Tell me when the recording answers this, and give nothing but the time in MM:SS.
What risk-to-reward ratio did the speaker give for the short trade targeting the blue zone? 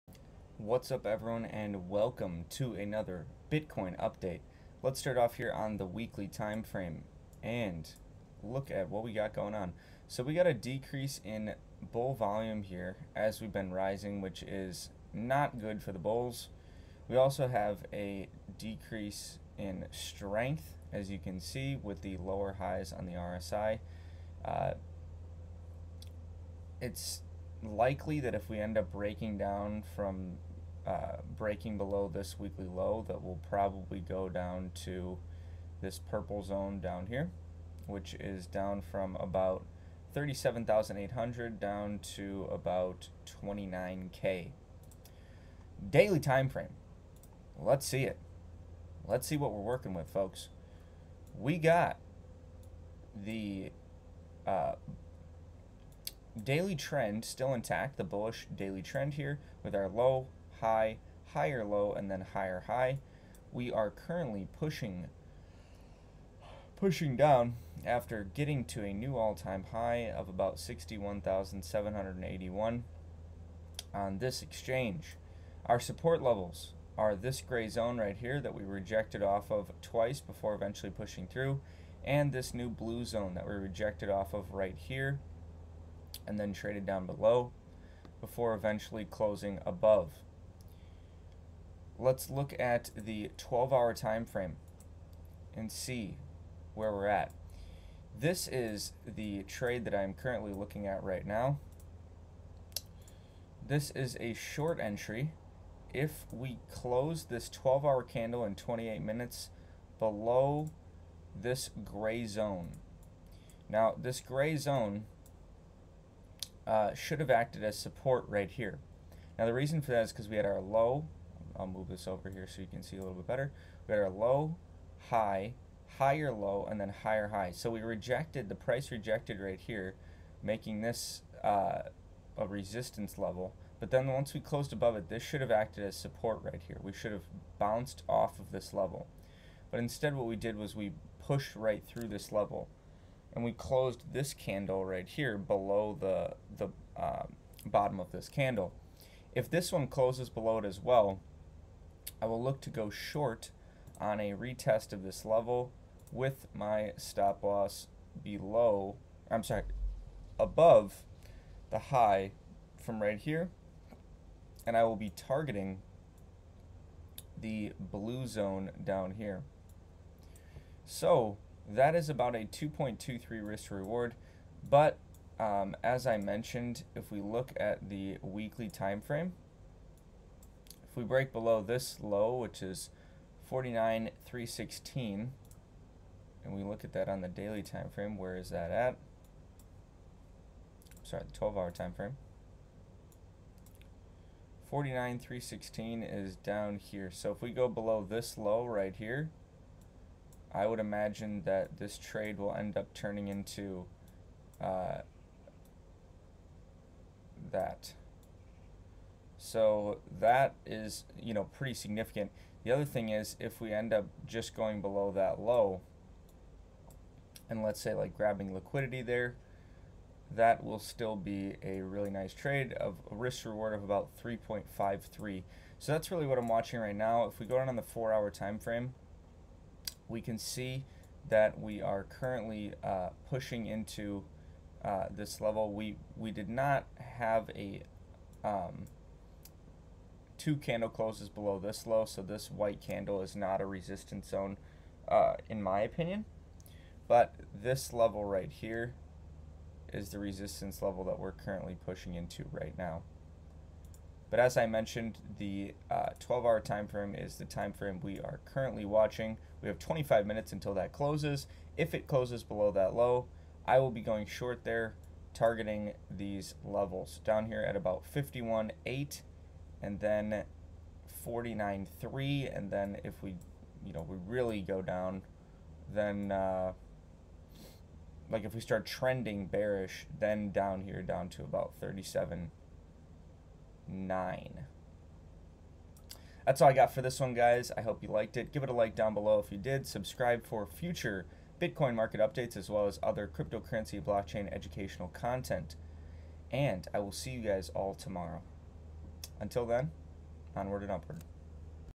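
02:52.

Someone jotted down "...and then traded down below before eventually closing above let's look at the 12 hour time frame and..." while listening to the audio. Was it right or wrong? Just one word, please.
right.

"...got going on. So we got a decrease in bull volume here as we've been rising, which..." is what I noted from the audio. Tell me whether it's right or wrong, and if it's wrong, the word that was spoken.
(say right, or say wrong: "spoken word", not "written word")
right.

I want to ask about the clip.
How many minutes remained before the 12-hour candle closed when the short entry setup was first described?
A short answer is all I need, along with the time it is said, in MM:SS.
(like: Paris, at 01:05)
28, at 01:48.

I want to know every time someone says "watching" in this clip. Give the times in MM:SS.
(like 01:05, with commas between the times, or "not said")
03:46, 04:18.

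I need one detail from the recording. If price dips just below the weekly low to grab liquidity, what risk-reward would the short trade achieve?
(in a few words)
3.53.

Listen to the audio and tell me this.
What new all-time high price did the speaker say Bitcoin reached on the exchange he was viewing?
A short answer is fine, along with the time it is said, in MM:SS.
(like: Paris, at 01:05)
61,781, at 01:10.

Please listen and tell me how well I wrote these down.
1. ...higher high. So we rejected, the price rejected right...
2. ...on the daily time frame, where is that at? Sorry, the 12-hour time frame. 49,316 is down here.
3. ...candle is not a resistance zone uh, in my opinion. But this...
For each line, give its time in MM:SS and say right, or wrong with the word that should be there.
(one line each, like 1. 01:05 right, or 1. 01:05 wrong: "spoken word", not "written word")
1. 02:07 right
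2. 03:07 right
3. 04:02 right.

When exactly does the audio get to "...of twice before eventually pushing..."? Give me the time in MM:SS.
01:19.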